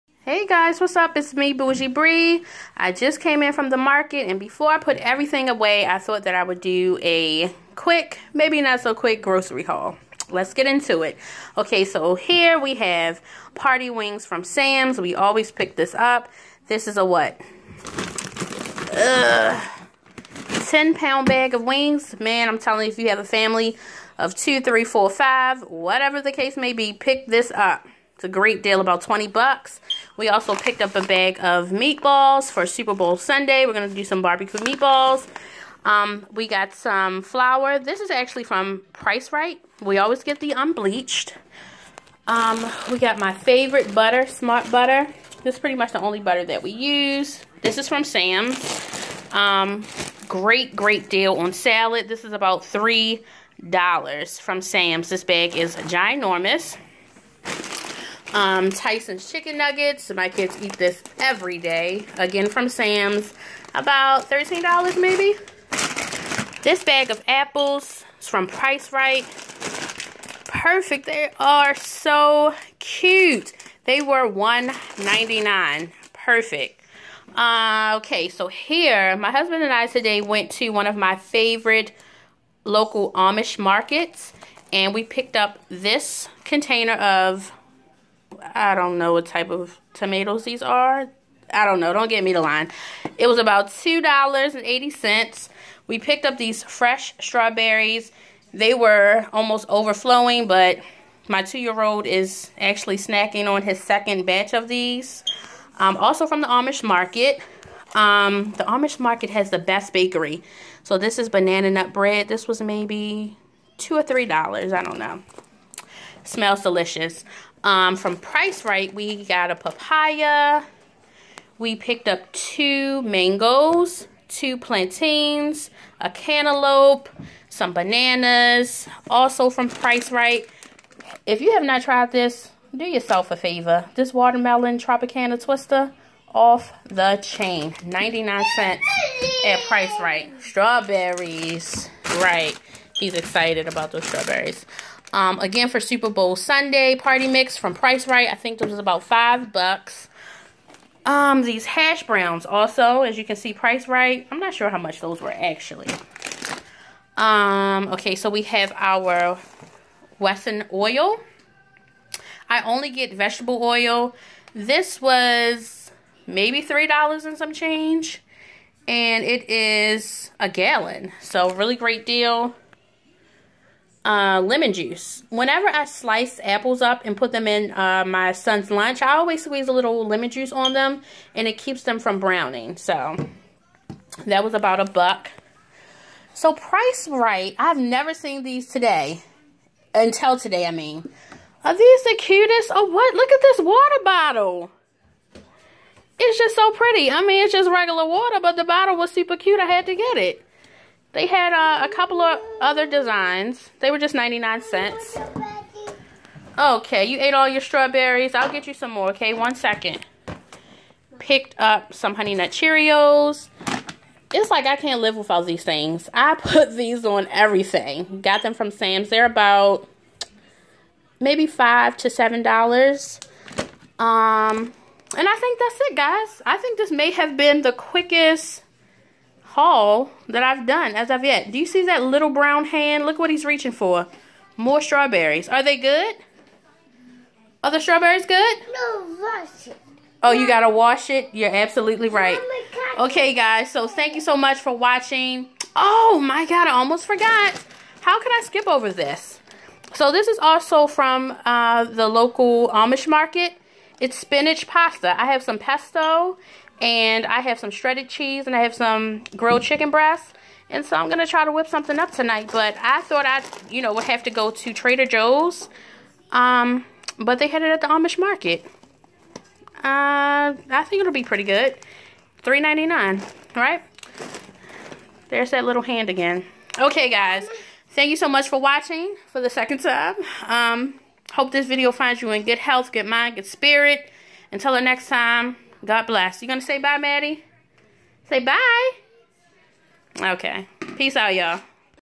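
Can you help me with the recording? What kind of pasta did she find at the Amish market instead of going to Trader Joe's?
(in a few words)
Spinach pasta.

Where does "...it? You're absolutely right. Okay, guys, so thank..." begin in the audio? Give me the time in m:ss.
4:01.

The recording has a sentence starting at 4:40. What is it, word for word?
Um, hope this video finds you in good health, good mind, good spirit.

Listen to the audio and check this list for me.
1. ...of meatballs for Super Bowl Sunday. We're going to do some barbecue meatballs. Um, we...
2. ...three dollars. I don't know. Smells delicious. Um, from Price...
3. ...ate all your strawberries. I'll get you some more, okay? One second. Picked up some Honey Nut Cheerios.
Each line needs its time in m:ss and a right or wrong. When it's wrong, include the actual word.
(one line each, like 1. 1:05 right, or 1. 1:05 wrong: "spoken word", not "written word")
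1. 0:31 right
2. 1:54 right
3. 3:27 right.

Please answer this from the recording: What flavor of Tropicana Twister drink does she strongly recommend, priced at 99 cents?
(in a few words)
Watermelon.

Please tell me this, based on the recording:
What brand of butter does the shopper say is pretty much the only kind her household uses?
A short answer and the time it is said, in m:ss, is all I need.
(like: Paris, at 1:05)
Smart Butter, at 0:44.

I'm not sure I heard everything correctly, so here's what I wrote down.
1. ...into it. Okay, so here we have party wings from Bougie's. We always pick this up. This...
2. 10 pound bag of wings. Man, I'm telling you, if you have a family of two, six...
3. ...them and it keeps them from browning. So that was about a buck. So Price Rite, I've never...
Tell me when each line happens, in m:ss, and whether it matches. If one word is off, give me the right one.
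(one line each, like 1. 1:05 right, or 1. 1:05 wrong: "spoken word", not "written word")
1. 0:10 wrong: "Sam", not "Bougie"
2. 0:20 wrong: "three", not "six"
3. 3:00 right.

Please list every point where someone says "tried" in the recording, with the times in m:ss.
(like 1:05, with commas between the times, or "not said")
2:11.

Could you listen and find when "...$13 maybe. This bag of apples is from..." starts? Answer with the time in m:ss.
1:04.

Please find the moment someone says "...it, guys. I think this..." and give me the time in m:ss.
3:45.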